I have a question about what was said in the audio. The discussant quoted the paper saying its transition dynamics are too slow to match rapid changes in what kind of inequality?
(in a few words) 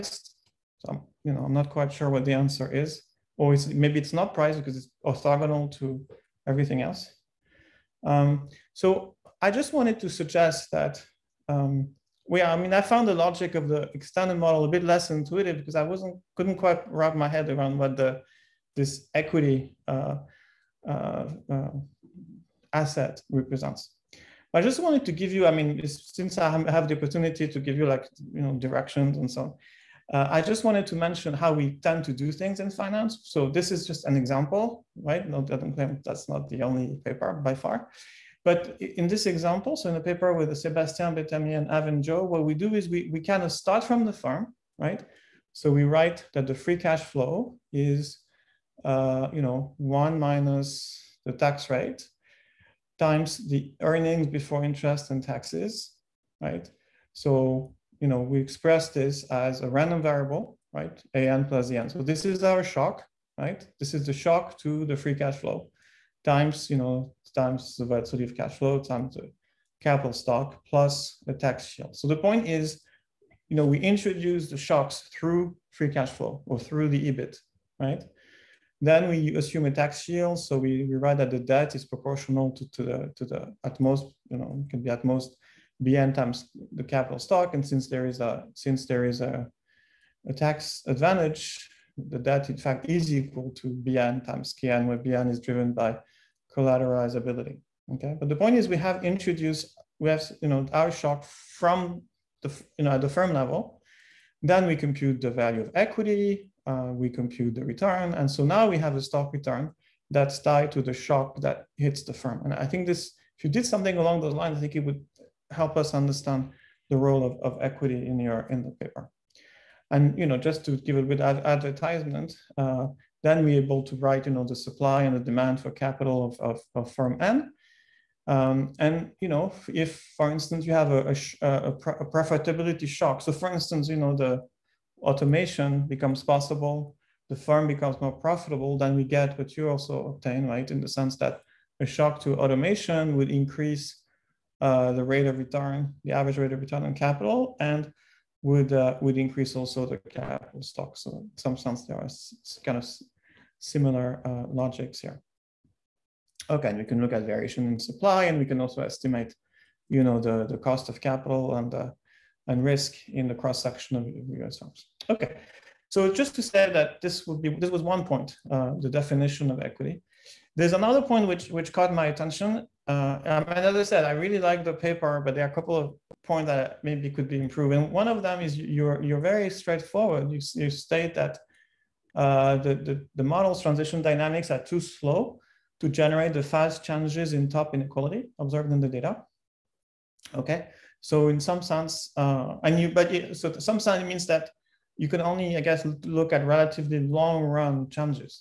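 top inequality.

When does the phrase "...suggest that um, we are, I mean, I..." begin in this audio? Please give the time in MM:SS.
00:10.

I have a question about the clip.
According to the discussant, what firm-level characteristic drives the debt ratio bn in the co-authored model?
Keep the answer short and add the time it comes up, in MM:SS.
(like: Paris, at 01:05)
collateralizability, at 01:36.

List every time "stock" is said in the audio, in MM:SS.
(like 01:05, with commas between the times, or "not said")
01:10, 01:27, 01:49, 02:30.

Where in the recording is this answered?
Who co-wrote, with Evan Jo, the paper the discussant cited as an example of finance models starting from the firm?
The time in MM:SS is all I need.
00:40.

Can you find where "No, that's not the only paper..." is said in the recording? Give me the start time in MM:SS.
00:35.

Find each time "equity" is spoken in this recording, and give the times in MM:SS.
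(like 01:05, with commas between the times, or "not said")
00:19, 01:45, 01:57, 02:49.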